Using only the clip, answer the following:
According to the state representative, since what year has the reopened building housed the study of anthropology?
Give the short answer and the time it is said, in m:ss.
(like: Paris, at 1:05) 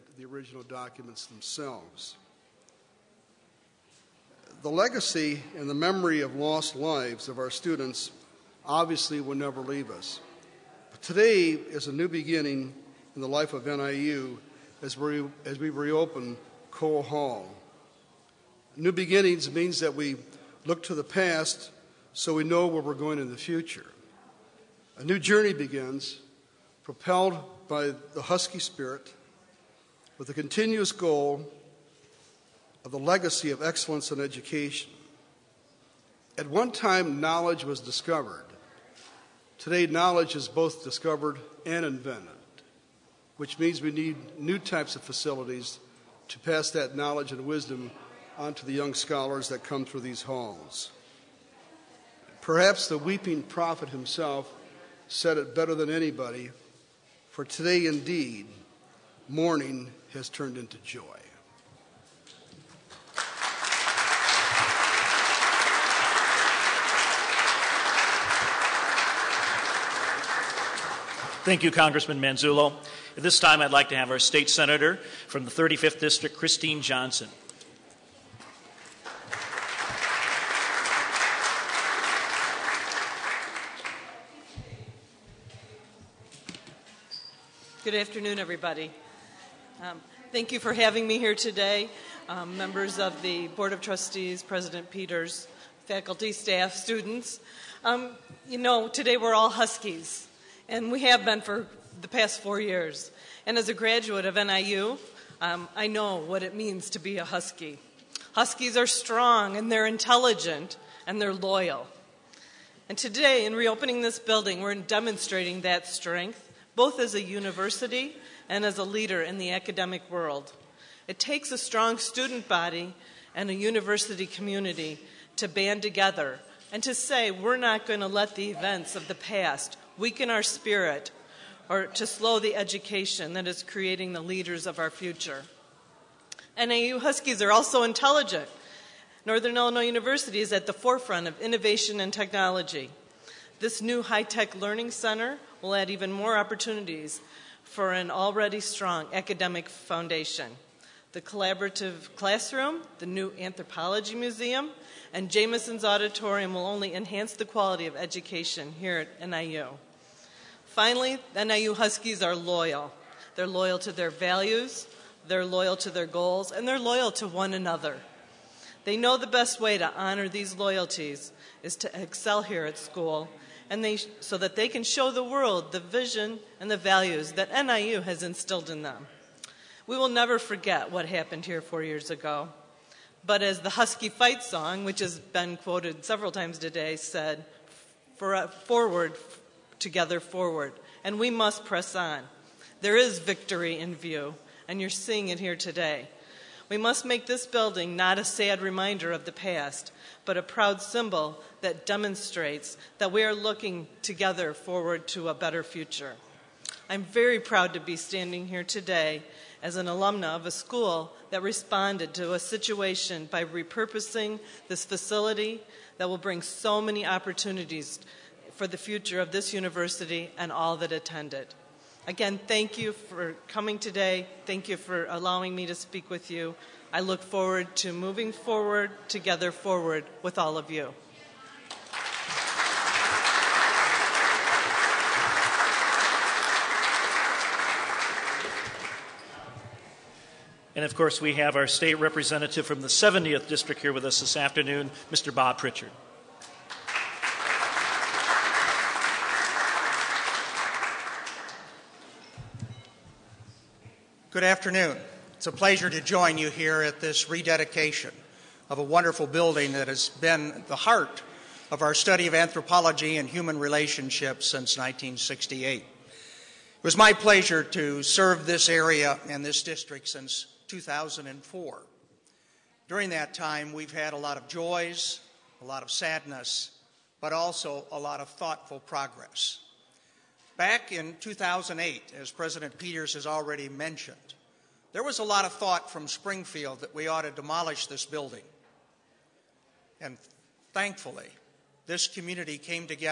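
1968, at 4:24.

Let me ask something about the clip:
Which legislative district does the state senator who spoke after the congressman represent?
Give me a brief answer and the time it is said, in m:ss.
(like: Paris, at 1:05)
35th District, at 1:15.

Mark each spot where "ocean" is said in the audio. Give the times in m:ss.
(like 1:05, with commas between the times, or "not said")
not said.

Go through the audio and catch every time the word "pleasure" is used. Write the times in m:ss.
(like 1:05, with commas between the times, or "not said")
4:15, 4:27.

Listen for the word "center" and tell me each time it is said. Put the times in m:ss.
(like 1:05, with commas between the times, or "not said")
2:24.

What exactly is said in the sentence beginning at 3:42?
Again, thank you for coming today.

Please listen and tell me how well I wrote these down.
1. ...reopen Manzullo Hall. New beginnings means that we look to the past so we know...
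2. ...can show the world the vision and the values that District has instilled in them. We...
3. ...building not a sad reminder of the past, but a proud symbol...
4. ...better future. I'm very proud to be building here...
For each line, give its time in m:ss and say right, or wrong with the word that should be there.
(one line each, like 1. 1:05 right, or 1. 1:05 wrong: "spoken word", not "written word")
1. 0:15 wrong: "Cole", not "Manzullo"
2. 2:54 wrong: "NIU", not "District"
3. 3:17 right
4. 3:25 wrong: "standing", not "building".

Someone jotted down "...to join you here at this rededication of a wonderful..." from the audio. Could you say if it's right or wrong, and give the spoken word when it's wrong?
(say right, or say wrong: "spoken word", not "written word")
right.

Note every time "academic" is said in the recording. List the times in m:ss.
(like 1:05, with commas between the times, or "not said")
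1:59, 2:29.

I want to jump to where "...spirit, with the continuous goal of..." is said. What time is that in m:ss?
0:28.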